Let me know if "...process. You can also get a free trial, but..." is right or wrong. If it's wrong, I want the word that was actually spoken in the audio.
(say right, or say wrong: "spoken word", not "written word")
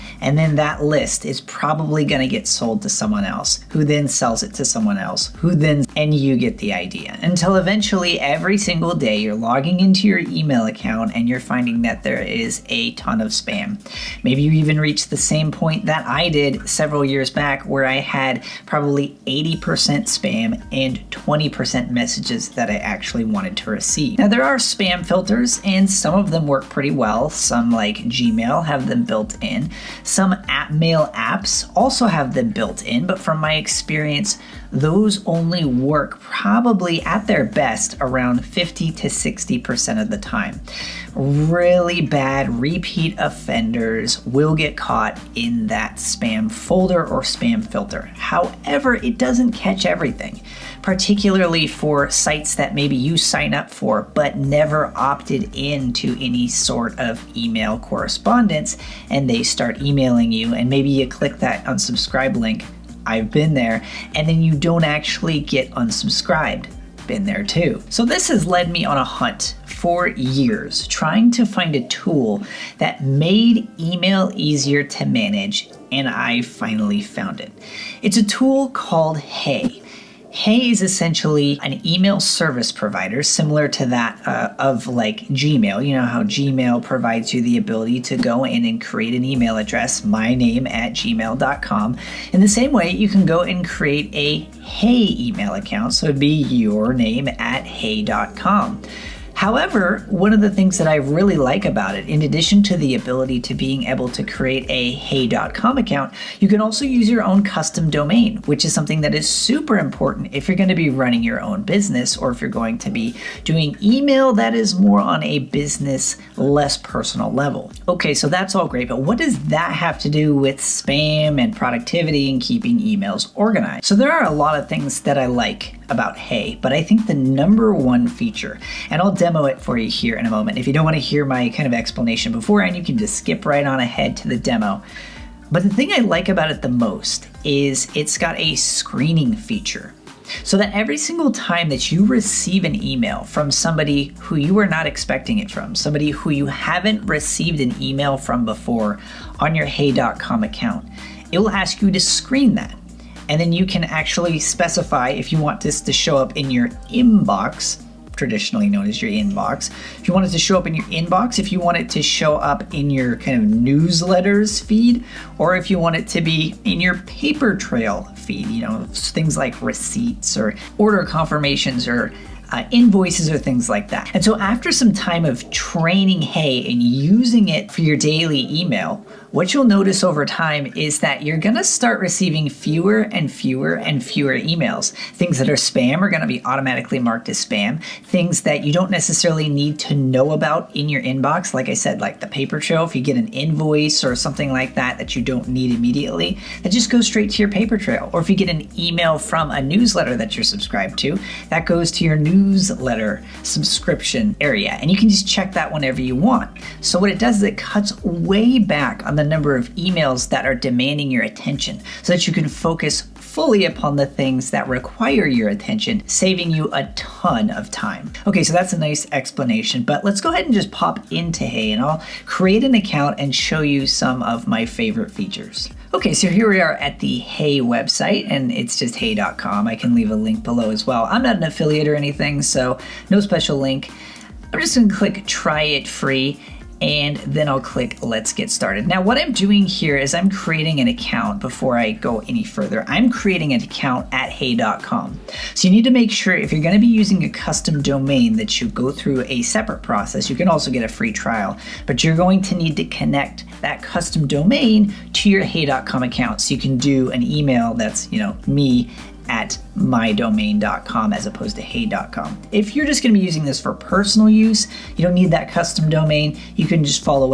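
right.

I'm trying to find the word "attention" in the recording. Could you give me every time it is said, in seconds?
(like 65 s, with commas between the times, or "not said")
211 s, 215 s.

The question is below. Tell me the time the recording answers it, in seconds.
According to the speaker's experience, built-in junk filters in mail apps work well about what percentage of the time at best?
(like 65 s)
38 s.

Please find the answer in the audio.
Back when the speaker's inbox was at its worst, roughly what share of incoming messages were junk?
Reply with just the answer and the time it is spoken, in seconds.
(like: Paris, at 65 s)
80%, at 19 s.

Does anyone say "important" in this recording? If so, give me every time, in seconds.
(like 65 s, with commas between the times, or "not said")
109 s.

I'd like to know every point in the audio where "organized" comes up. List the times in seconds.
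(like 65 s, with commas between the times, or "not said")
123 s.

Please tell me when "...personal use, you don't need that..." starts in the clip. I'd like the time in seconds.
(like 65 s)
263 s.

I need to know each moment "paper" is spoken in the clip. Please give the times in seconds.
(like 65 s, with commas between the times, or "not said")
167 s, 192 s, 197 s.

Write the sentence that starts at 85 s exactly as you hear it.
You know how Gmail provides you the ability to go in and create an email address, my name at gmail.com.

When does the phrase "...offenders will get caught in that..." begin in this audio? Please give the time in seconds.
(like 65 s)
43 s.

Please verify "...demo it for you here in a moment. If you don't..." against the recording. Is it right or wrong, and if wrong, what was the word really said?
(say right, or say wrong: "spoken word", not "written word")
right.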